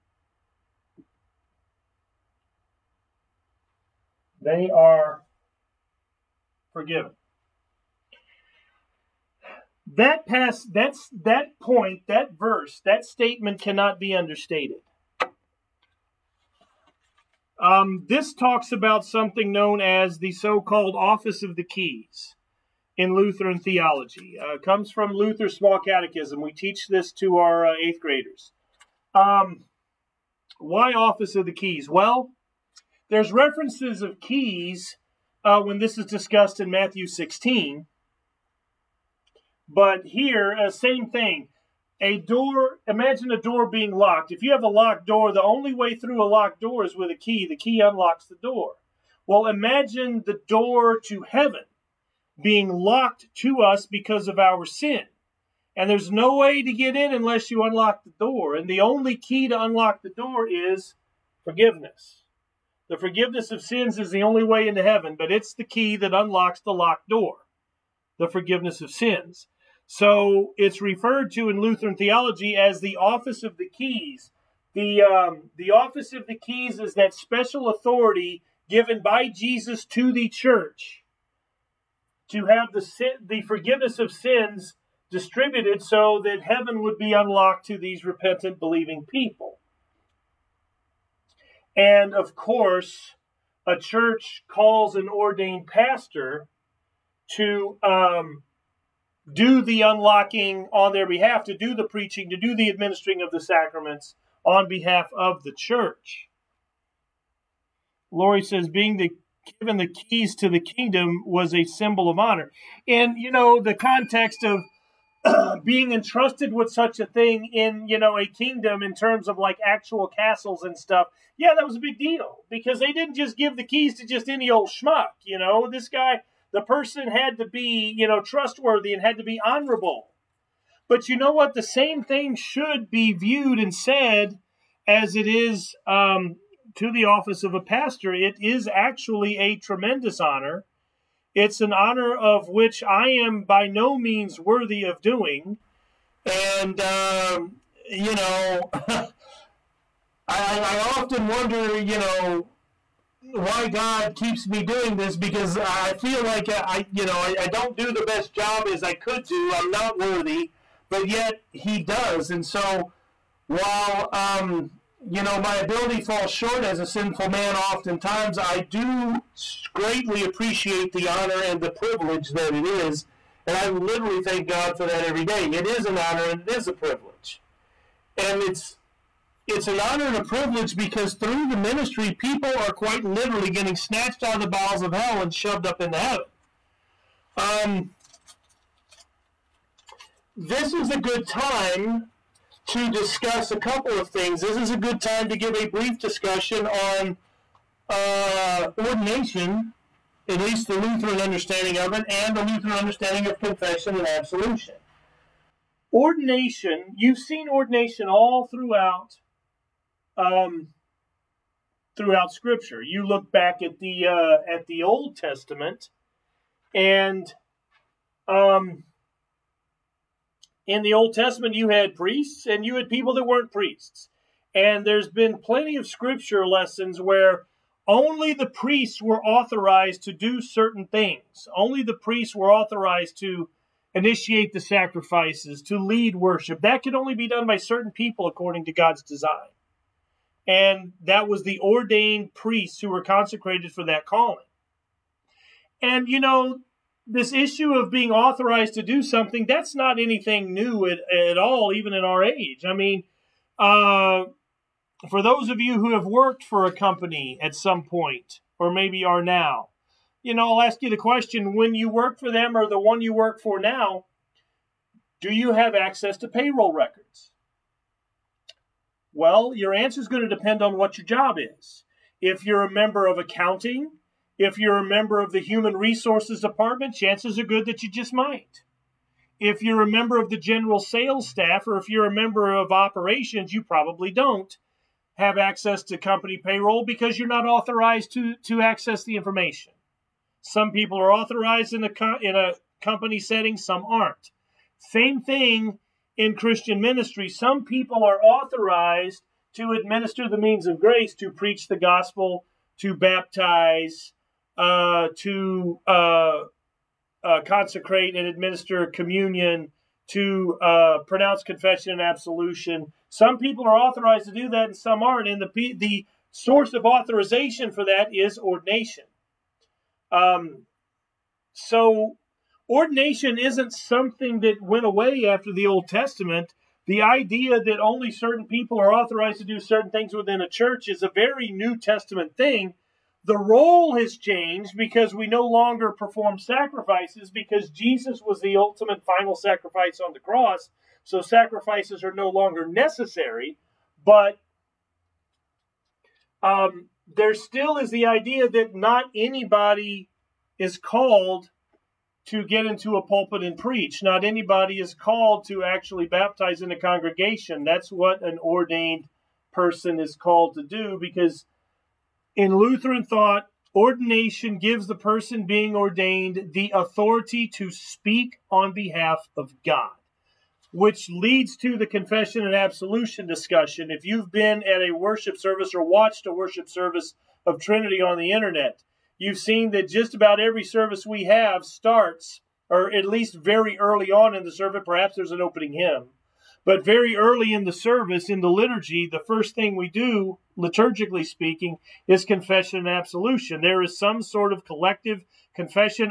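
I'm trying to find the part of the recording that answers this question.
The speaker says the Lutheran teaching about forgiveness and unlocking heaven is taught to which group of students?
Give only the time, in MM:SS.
00:27.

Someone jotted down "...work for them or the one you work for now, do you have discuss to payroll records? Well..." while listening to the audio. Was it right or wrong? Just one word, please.
wrong.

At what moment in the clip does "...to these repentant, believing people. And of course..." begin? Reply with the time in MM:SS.
01:27.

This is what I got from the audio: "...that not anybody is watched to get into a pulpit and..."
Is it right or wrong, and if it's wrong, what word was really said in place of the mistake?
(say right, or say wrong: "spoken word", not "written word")
wrong: "called", not "watched".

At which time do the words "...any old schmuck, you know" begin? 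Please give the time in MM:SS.
02:04.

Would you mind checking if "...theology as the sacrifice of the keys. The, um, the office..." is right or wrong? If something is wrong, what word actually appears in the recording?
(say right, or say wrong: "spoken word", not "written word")
wrong: "office", not "sacrifice".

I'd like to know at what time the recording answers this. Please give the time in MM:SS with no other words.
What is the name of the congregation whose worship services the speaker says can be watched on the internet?
06:17.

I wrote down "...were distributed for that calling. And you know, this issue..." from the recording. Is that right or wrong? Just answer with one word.
wrong.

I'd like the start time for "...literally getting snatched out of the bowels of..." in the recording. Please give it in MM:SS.
03:03.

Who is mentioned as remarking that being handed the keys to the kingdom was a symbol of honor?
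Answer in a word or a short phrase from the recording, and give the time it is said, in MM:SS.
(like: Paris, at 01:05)
Lori, at 01:48.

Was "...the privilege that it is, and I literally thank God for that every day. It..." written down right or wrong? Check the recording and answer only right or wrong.
right.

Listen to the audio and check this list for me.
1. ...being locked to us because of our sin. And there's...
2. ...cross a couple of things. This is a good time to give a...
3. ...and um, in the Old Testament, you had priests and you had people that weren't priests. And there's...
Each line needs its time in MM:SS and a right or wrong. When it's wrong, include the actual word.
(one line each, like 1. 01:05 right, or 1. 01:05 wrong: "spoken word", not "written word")
1. 00:52 right
2. 03:12 wrong: "discuss", not "cross"
3. 03:36 right.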